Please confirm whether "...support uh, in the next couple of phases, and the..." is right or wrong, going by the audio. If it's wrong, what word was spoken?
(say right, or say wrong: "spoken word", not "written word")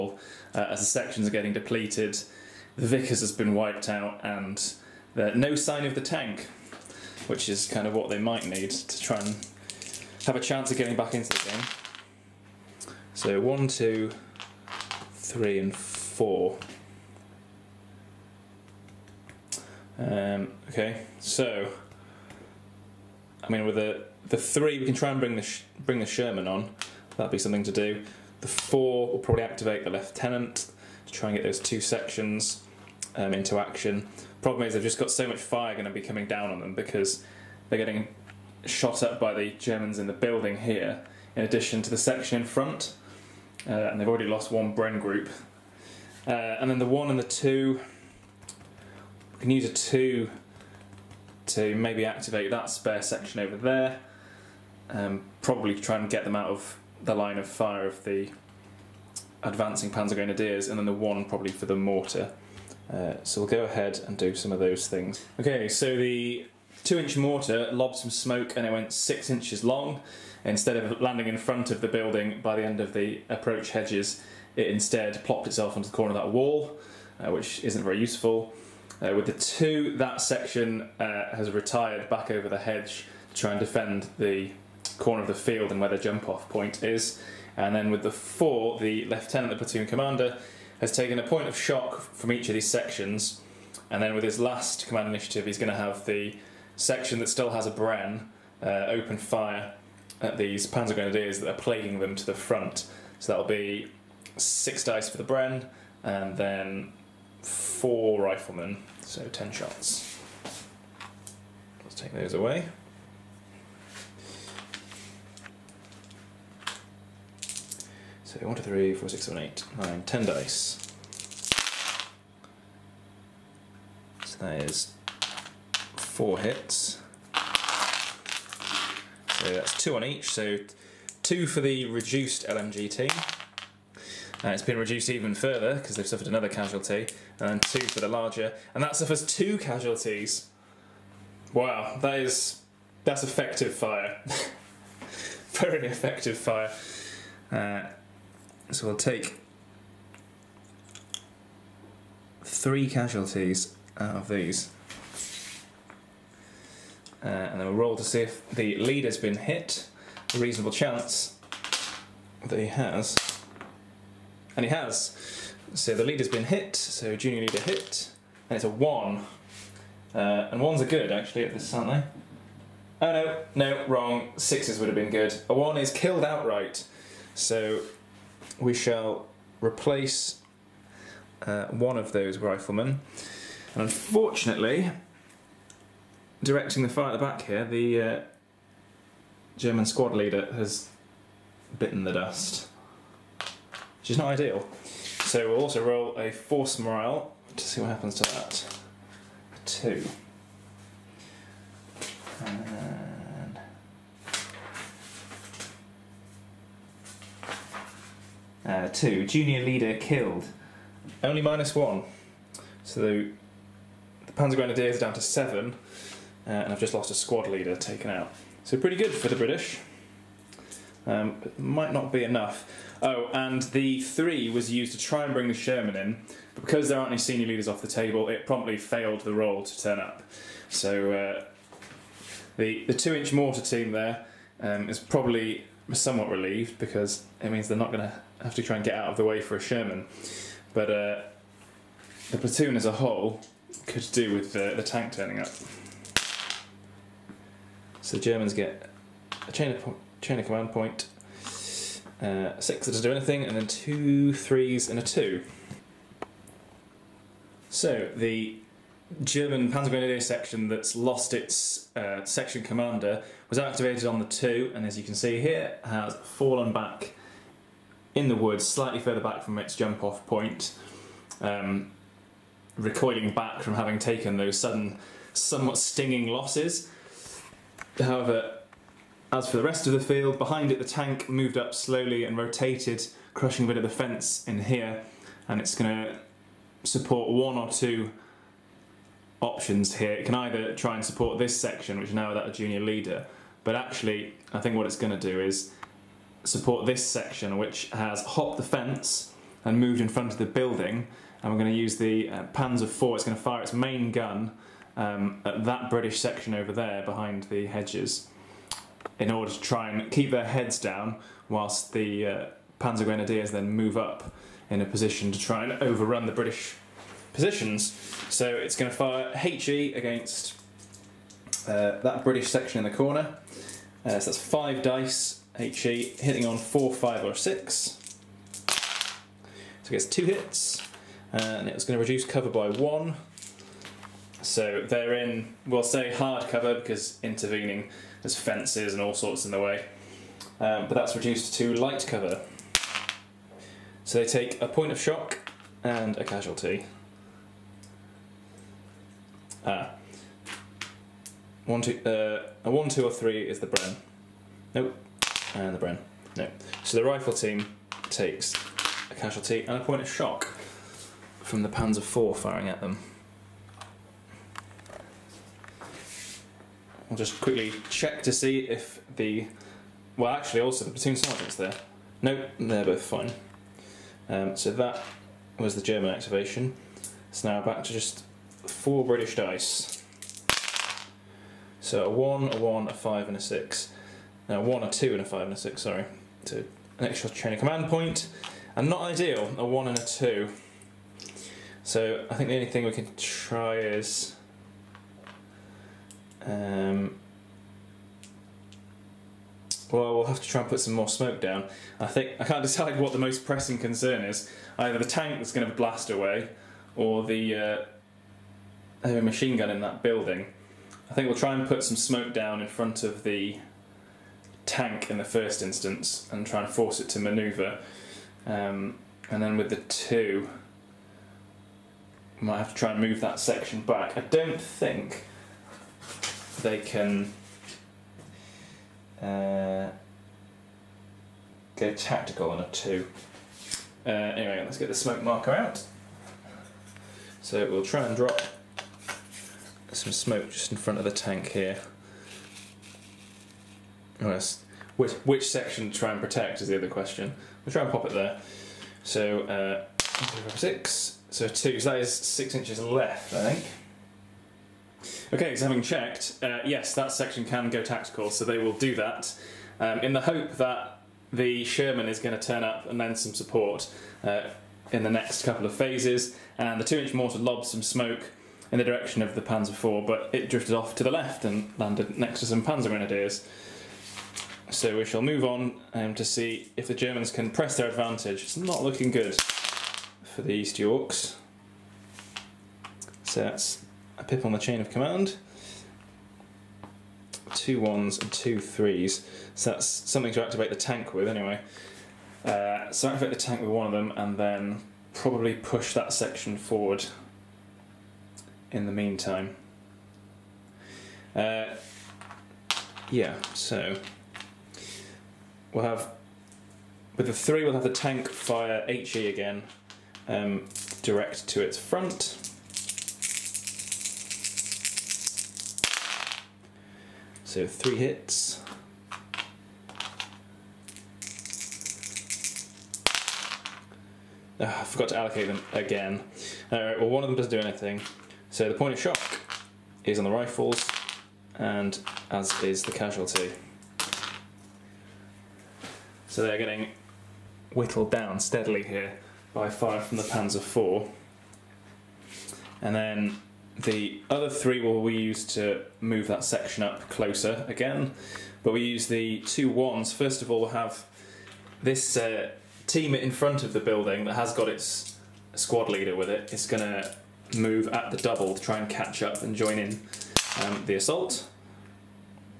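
right.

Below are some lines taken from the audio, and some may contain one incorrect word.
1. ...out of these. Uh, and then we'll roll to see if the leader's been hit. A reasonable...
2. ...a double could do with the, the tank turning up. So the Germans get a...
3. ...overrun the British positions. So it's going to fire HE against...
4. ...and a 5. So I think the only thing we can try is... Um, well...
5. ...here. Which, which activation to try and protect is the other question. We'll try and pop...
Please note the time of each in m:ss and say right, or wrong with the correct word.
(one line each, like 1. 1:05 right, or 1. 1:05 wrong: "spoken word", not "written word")
1. 2:33 right
2. 4:02 wrong: "whole", not "double"
3. 5:15 right
4. 6:29 wrong: "2", not "5"
5. 7:21 wrong: "section", not "activation".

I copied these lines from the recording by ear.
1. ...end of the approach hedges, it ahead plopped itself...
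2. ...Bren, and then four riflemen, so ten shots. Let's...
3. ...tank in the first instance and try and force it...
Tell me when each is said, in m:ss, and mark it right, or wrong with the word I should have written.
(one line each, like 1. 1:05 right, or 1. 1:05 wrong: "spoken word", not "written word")
1. 1:12 wrong: "instead", not "ahead"
2. 1:45 right
3. 6:54 right.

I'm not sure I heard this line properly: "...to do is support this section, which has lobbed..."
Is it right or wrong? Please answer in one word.
wrong.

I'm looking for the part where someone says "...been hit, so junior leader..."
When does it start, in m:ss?
2:46.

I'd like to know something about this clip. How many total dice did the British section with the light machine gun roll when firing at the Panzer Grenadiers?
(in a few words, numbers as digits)
10.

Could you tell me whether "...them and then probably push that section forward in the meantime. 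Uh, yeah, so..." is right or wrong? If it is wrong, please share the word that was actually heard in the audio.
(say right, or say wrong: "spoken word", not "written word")
right.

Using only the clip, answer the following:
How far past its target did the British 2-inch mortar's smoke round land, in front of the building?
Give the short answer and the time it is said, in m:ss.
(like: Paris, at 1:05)
6 inches, at 1:08.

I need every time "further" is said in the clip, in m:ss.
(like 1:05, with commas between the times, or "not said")
2:15, 4:28.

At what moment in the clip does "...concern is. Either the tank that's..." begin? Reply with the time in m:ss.
6:43.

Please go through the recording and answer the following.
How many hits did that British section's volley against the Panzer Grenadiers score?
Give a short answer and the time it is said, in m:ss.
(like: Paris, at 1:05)
4, at 2:05.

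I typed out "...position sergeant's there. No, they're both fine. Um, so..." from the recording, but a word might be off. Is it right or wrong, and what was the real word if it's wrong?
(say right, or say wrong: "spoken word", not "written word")
wrong: "platoon", not "position".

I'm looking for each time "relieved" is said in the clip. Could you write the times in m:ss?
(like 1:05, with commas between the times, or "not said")
3:56.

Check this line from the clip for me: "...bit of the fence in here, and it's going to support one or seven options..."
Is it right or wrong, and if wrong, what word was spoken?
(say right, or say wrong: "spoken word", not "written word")
wrong: "two", not "seven".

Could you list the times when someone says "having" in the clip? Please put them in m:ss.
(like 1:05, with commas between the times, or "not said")
4:33, 7:35.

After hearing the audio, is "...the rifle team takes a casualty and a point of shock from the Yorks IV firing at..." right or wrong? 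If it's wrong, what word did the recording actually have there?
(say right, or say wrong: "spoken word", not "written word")
wrong: "Panzer", not "Yorks".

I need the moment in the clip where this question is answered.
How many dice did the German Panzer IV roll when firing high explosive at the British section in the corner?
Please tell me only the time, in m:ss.
5:24.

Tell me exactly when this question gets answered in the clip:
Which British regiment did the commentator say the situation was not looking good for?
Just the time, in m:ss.
8:00.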